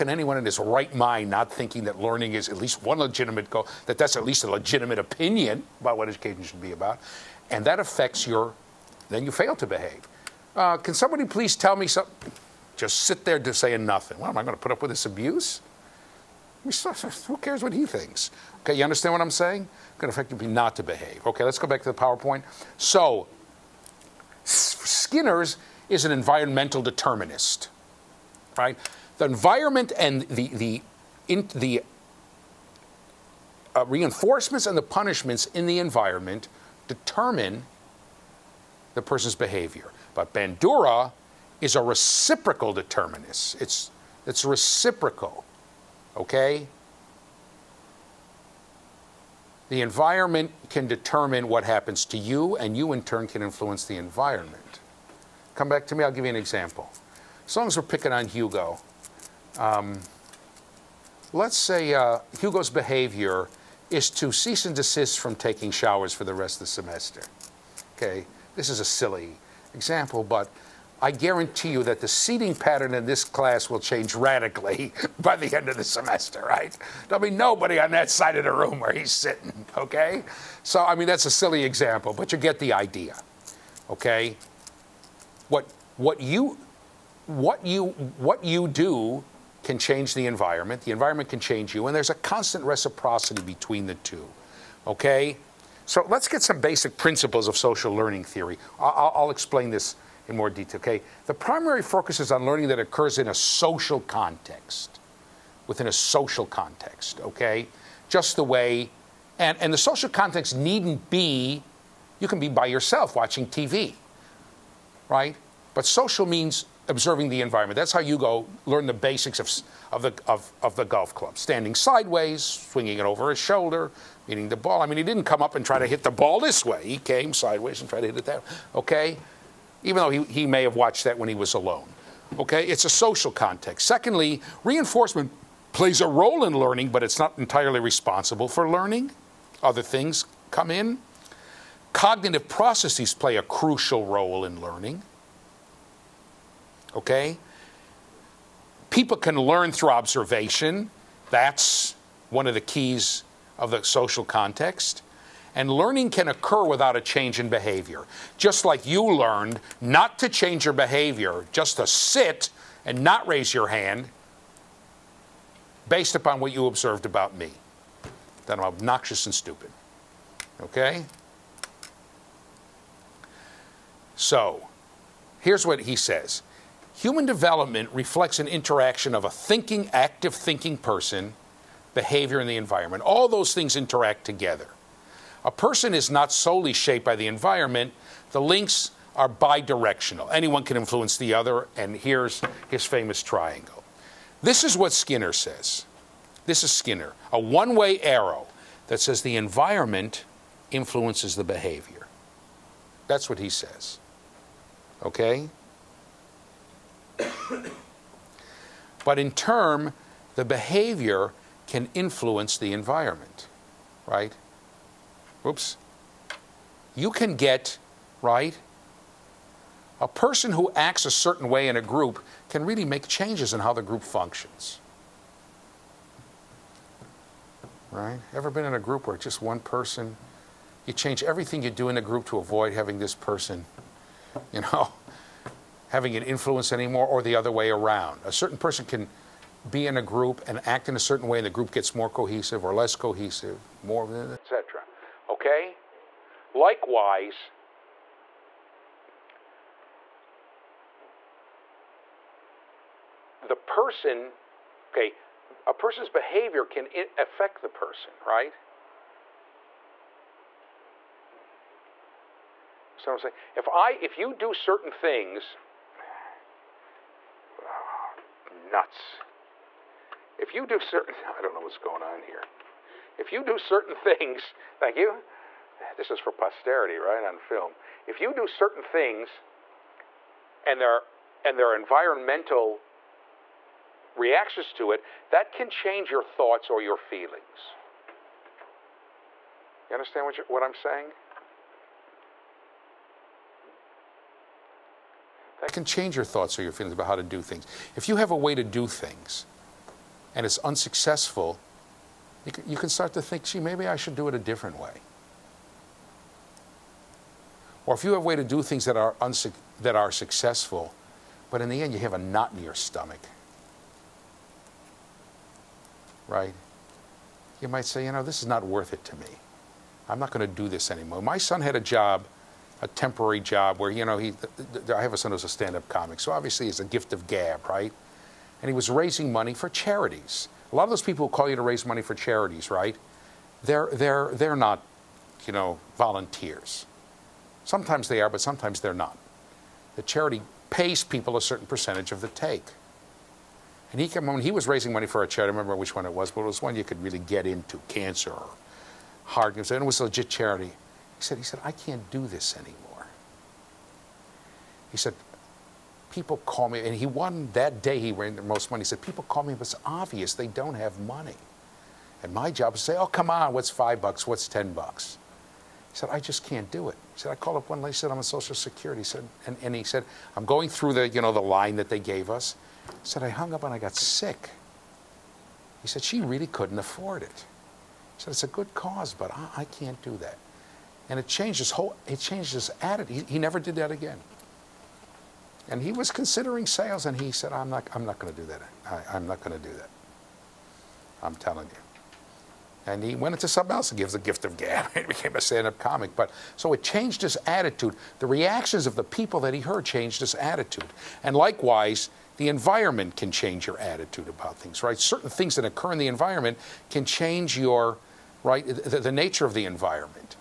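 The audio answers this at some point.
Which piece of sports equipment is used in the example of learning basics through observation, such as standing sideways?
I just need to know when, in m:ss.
2:00.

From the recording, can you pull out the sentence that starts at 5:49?
And it was a legit charity.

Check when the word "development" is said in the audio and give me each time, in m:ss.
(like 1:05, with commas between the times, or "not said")
2:57.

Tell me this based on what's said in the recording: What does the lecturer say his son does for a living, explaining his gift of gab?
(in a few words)
stand up comic.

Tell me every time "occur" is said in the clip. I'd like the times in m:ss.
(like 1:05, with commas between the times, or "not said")
1:42, 2:36, 6:45.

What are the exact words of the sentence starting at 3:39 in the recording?
A person who acts a certain way in a group can really make changes in how the group functions.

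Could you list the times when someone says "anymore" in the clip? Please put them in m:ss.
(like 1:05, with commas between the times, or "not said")
3:56, 5:20, 5:52.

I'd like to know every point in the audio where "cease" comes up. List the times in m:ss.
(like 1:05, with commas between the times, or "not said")
1:04.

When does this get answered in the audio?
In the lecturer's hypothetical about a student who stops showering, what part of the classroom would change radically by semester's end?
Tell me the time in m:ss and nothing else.
1:12.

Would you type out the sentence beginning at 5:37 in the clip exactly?
Sometimes they are, but sometimes they're not.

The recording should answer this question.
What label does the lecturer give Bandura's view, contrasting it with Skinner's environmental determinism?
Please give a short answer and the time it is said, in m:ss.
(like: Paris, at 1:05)
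reciprocal determinist, at 0:41.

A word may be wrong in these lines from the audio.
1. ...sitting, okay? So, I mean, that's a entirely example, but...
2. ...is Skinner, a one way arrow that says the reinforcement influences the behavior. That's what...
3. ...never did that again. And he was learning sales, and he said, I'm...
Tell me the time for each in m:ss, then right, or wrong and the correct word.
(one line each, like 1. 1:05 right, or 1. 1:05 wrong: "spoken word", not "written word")
1. 1:19 wrong: "silly", not "entirely"
2. 3:16 wrong: "environment", not "reinforcement"
3. 6:23 wrong: "considering", not "learning".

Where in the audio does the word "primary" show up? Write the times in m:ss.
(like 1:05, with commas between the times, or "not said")
1:41.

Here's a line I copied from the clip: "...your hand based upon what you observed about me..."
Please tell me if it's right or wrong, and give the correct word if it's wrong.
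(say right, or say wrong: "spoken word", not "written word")
right.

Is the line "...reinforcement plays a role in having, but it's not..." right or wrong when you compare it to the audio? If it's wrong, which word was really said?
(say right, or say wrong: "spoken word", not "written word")
wrong: "learning", not "having".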